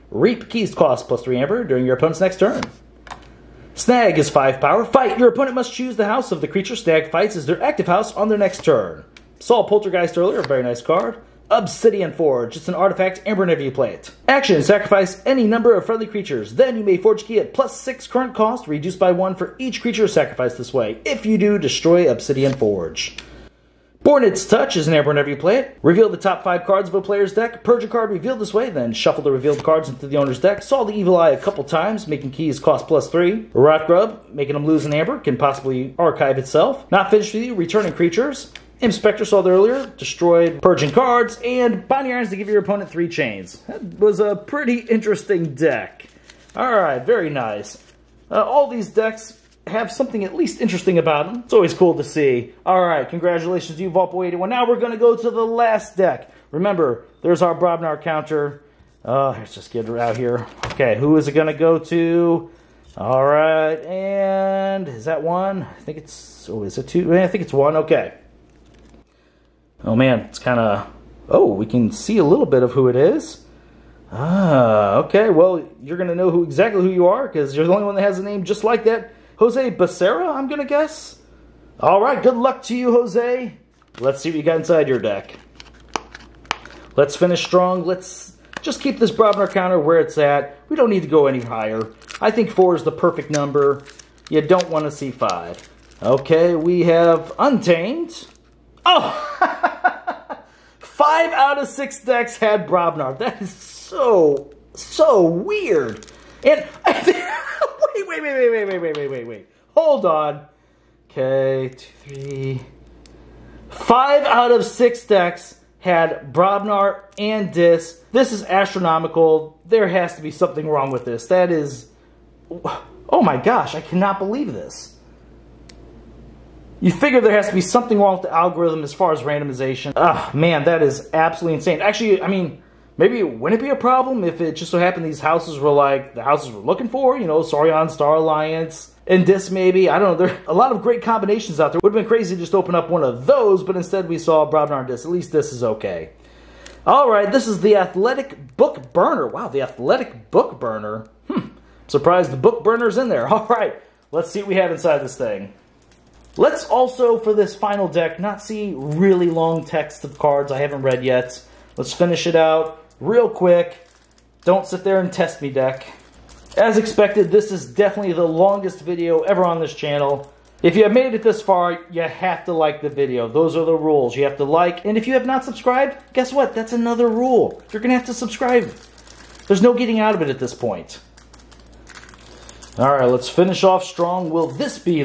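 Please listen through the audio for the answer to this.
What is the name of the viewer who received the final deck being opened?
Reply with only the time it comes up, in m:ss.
1:19.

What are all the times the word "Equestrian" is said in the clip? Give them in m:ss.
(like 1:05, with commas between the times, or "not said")
not said.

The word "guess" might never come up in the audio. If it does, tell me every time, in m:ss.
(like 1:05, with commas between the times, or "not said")
1:20, 2:56.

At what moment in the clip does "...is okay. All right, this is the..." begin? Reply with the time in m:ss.
2:25.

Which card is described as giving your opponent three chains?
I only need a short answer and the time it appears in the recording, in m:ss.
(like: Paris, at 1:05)
Binding Irons, at 0:41.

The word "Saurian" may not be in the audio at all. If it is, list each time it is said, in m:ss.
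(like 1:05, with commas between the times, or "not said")
2:17.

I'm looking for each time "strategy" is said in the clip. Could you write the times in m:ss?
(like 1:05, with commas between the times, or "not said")
not said.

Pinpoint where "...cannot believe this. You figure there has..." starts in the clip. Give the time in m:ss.
2:03.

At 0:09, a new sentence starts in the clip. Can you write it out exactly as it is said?
Saw Poltergeist earlier, very nice card.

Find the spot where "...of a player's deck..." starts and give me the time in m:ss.
0:26.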